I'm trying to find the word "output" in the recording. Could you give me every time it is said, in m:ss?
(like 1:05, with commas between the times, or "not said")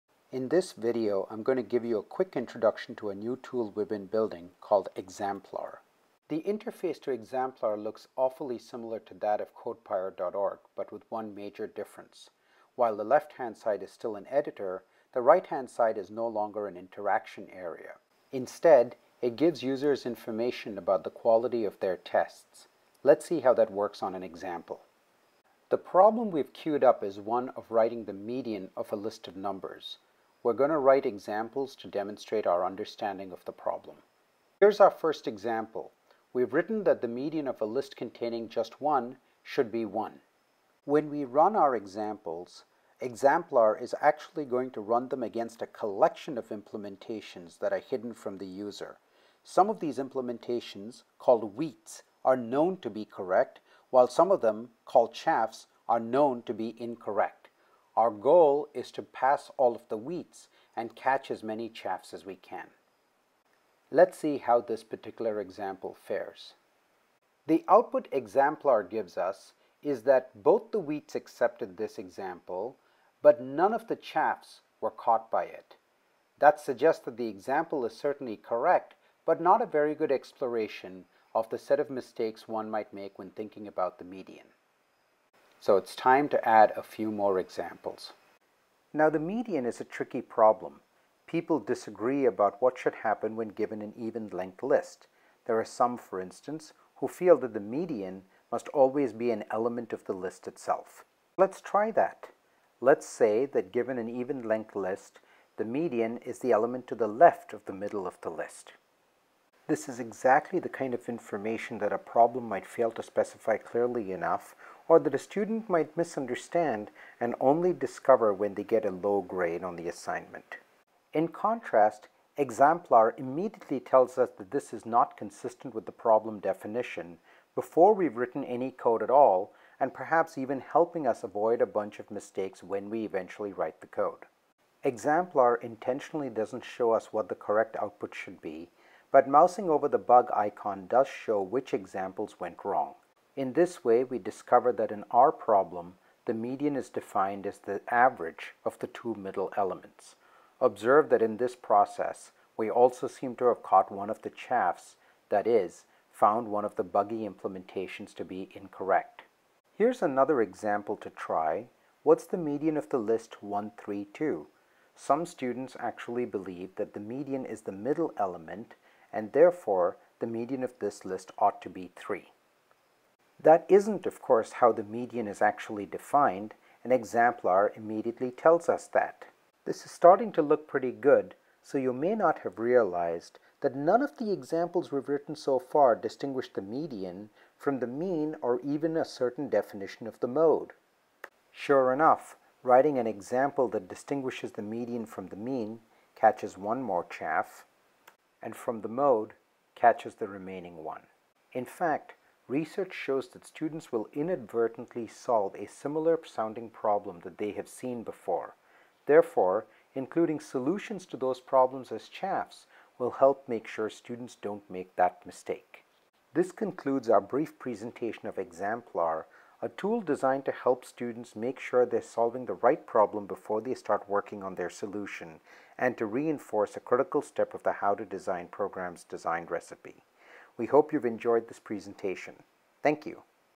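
1:07, 2:17.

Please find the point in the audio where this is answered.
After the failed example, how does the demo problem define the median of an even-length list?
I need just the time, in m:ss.
2:27.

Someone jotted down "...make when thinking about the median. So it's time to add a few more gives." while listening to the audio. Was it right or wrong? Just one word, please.
wrong.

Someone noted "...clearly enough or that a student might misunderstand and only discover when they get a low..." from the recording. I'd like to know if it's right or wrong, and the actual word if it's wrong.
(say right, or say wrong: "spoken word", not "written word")
right.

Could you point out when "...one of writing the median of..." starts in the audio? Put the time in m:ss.
0:27.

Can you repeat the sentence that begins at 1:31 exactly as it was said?
People disagree about what should happen when given an even length list.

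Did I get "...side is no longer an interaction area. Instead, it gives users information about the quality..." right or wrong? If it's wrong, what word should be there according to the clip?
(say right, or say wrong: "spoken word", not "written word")
right.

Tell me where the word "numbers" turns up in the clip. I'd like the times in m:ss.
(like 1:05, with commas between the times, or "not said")
0:29.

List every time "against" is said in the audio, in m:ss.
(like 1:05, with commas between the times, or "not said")
0:45.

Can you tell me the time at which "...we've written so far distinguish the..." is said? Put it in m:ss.
3:04.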